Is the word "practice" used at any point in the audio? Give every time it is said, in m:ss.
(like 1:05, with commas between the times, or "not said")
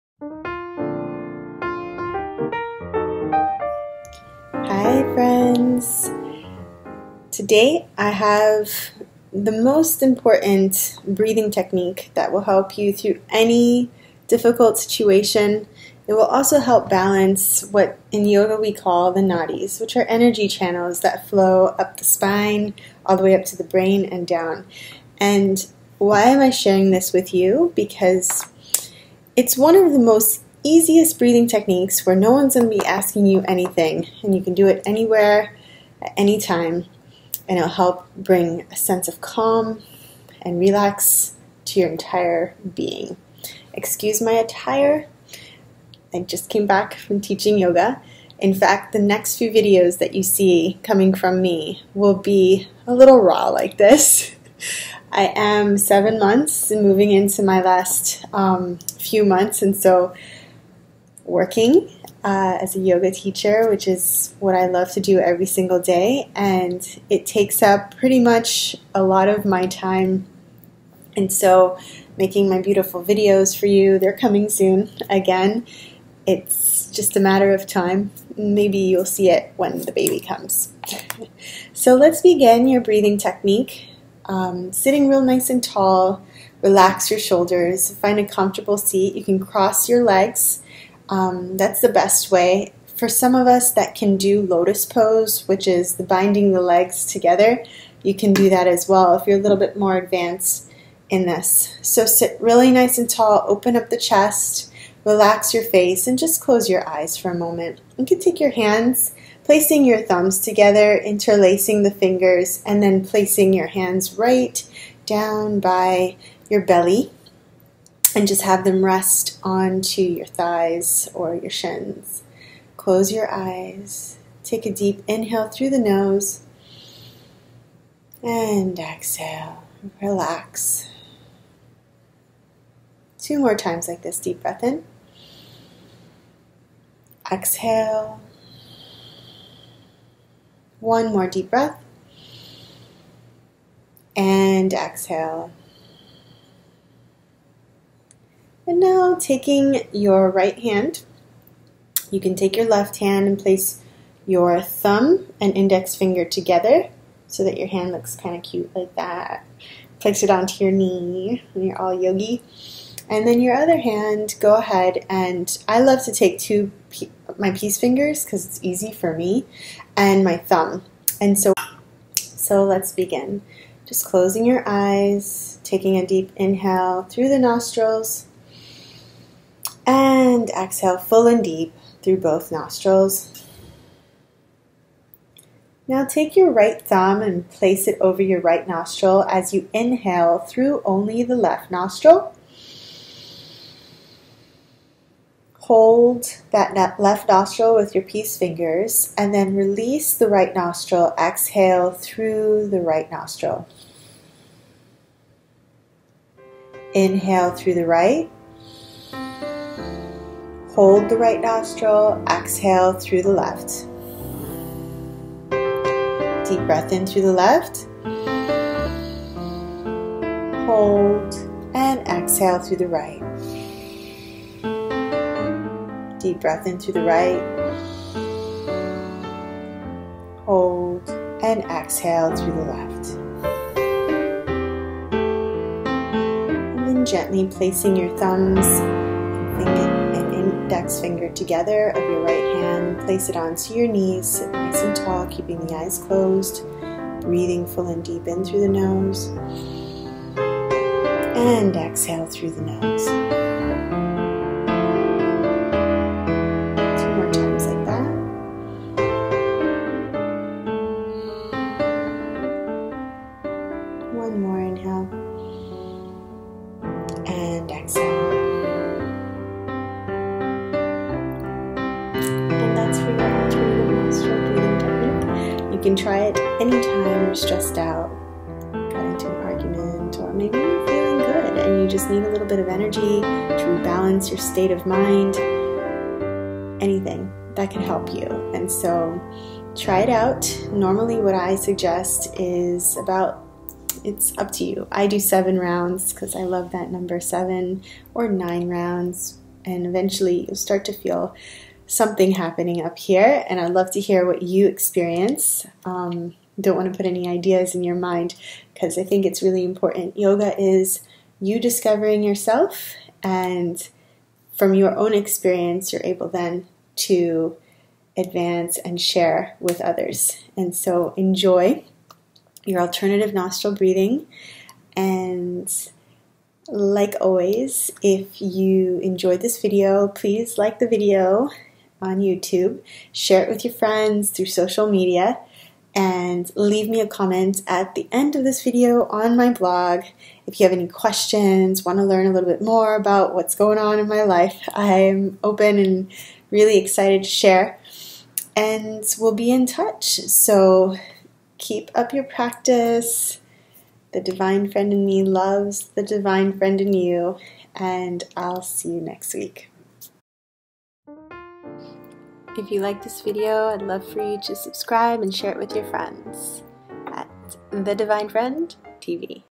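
5:52.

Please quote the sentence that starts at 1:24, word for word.
Um, sitting real nice and tall, relax your shoulders, find a comfortable seat.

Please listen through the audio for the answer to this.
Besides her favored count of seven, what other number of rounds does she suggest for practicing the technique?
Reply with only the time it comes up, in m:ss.
4:58.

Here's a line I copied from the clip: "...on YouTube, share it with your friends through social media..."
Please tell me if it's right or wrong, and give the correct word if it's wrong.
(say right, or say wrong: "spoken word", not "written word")
right.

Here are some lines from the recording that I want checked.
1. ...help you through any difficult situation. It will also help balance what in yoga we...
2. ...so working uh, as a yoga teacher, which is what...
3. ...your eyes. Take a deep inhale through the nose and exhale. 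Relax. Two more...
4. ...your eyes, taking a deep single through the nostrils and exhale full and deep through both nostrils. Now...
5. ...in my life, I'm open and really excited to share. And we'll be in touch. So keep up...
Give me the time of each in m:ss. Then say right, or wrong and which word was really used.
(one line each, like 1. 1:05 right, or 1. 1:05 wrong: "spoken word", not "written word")
1. 0:12 right
2. 0:59 right
3. 2:03 right
4. 2:54 wrong: "inhale", not "single"
5. 5:43 right.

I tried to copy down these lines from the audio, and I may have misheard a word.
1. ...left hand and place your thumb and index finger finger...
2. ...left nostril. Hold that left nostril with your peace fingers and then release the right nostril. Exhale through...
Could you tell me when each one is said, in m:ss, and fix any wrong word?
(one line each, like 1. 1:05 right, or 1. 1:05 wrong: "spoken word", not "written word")
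1. 2:32 wrong: "together", not "finger"
2. 3:11 right.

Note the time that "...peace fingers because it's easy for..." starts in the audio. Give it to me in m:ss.
2:47.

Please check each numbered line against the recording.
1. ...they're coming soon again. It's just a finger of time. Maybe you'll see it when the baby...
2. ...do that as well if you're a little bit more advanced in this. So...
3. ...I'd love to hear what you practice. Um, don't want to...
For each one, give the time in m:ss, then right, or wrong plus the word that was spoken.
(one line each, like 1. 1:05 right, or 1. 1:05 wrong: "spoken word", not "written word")
1. 1:13 wrong: "matter", not "finger"
2. 1:38 right
3. 5:03 wrong: "experience", not "practice".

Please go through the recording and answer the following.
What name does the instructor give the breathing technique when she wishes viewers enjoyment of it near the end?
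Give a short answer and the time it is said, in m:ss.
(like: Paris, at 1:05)
alternative nostril breathing, at 5:22.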